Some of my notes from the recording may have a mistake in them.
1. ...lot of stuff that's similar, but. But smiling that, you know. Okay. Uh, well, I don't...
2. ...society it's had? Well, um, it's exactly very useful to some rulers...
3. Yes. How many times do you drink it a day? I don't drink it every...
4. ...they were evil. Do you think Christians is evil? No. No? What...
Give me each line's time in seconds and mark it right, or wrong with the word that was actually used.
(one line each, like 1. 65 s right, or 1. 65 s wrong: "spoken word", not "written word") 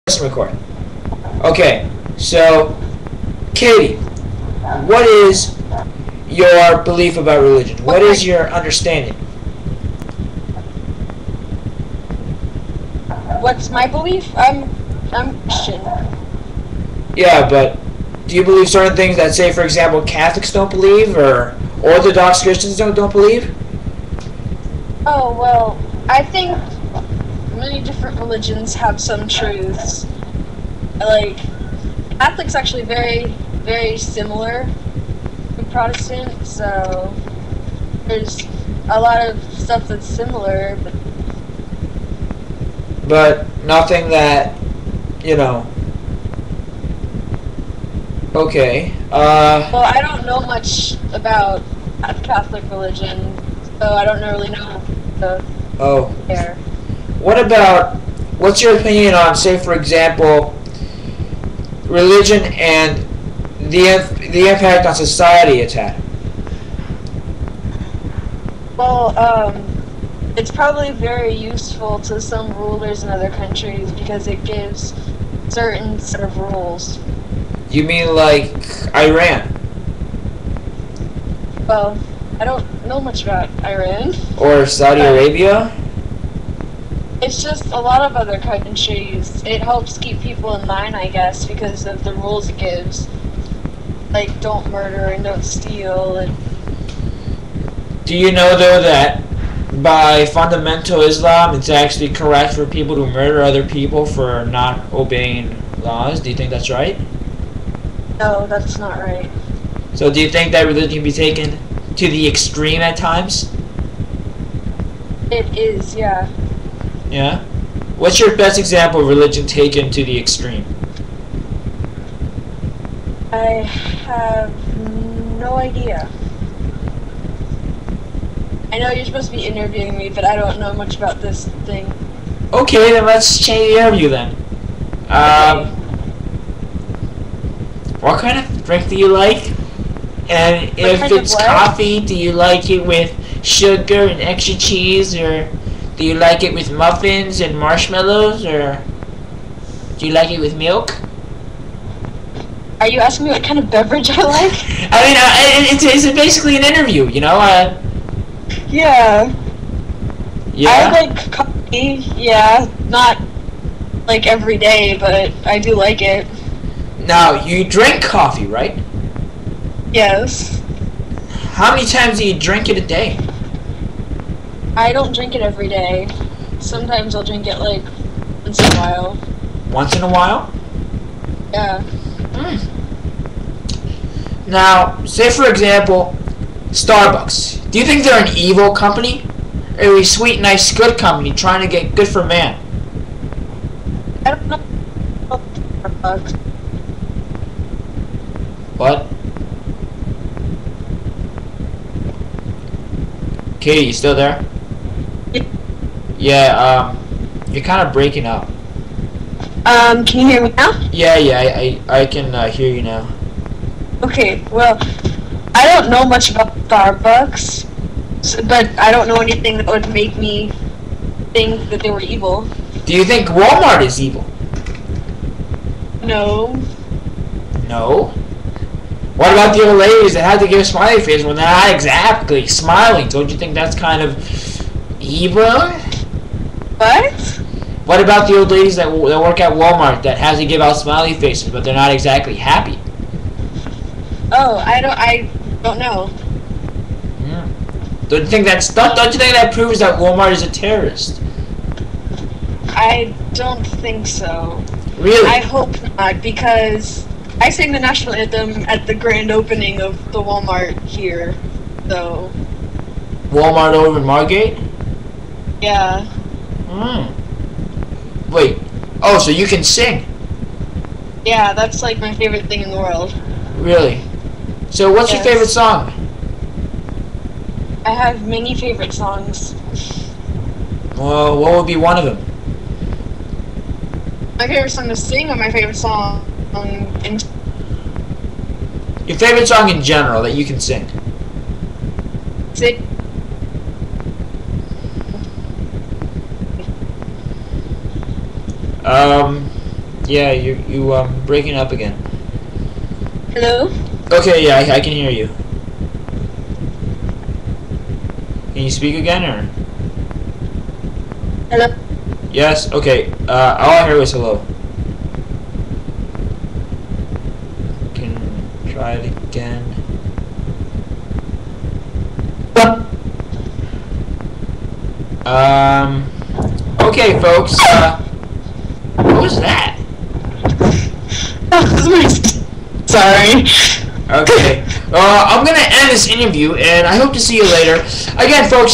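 1. 38 s wrong: "nothing", not "smiling"
2. 64 s wrong: "probably", not "exactly"
3. 169 s right
4. 221 s wrong: "Walmart", not "Christians".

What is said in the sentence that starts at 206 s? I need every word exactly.
Yeah, um, you're kind of breaking up.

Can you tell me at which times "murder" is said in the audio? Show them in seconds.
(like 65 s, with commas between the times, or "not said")
94 s, 103 s.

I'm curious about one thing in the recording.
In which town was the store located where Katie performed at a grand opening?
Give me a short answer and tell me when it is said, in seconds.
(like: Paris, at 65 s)
Margate, at 264 s.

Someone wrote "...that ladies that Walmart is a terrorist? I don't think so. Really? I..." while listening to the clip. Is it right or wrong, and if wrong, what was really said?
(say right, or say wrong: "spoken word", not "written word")
wrong: "proves", not "ladies".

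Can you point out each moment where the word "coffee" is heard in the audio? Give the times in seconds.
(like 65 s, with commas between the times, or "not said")
141 s, 161 s, 168 s.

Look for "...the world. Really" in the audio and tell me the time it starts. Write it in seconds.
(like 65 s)
272 s.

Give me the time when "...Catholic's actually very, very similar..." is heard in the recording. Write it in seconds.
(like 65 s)
32 s.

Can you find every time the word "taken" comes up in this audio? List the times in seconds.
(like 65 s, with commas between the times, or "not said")
111 s, 119 s.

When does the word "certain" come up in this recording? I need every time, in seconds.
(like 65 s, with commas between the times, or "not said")
18 s, 75 s.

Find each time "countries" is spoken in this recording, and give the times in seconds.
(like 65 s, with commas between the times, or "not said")
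73 s, 88 s.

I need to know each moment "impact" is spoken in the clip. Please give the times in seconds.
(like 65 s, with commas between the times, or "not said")
64 s.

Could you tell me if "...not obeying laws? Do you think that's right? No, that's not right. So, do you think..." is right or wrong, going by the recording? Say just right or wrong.
right.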